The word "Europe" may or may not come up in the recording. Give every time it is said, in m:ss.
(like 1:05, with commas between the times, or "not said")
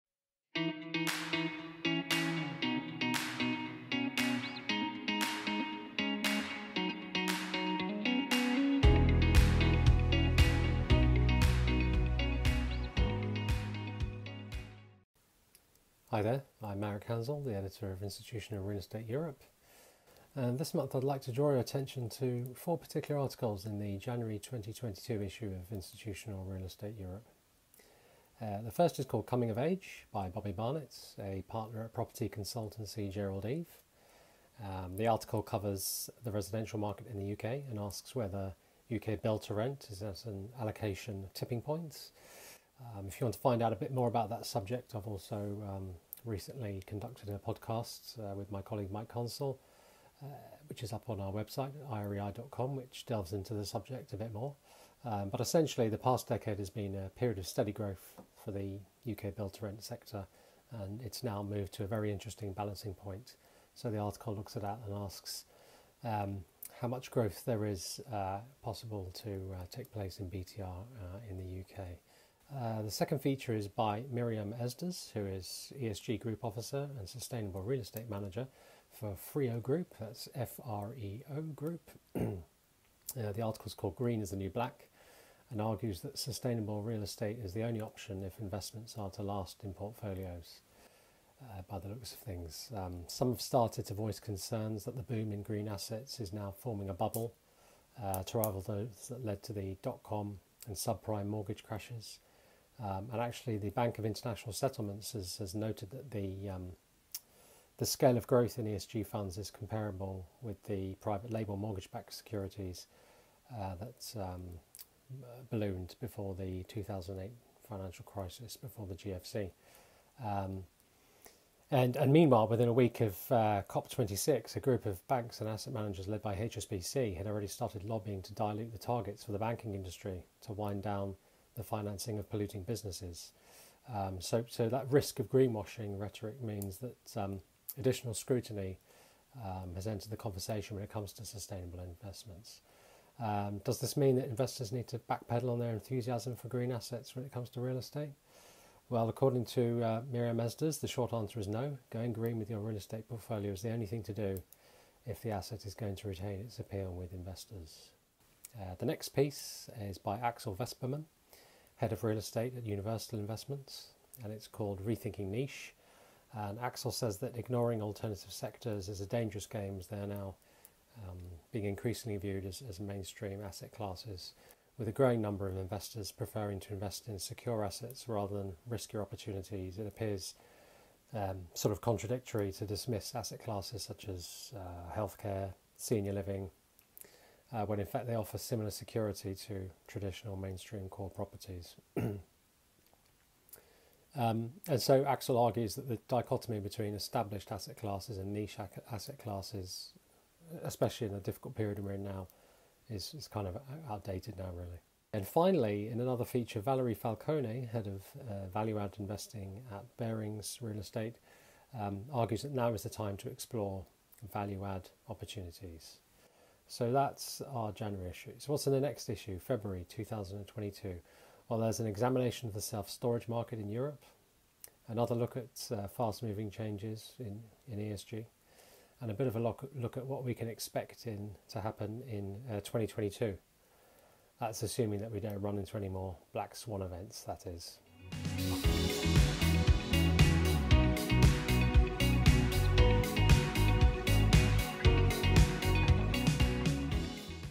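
0:19, 0:26, 3:43.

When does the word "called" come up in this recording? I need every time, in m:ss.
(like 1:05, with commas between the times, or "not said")
0:29, 1:23, 2:44.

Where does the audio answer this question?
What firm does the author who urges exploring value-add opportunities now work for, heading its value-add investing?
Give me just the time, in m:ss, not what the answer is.
3:29.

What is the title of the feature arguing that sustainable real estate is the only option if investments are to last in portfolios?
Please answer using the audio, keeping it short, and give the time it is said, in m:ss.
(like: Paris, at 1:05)
Green is the New Black, at 1:23.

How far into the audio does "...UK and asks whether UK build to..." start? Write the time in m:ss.
0:37.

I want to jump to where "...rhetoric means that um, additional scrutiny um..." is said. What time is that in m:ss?
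2:15.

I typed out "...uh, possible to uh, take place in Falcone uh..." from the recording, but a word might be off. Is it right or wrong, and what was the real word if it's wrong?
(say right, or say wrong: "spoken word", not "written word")
wrong: "BTR", not "Falcone".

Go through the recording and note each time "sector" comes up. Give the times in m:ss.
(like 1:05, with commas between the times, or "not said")
0:59, 2:48.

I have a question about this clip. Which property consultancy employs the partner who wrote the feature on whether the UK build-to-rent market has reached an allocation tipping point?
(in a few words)
Gerald Eve.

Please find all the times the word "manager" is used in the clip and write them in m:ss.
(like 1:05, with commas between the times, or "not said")
1:18, 2:05.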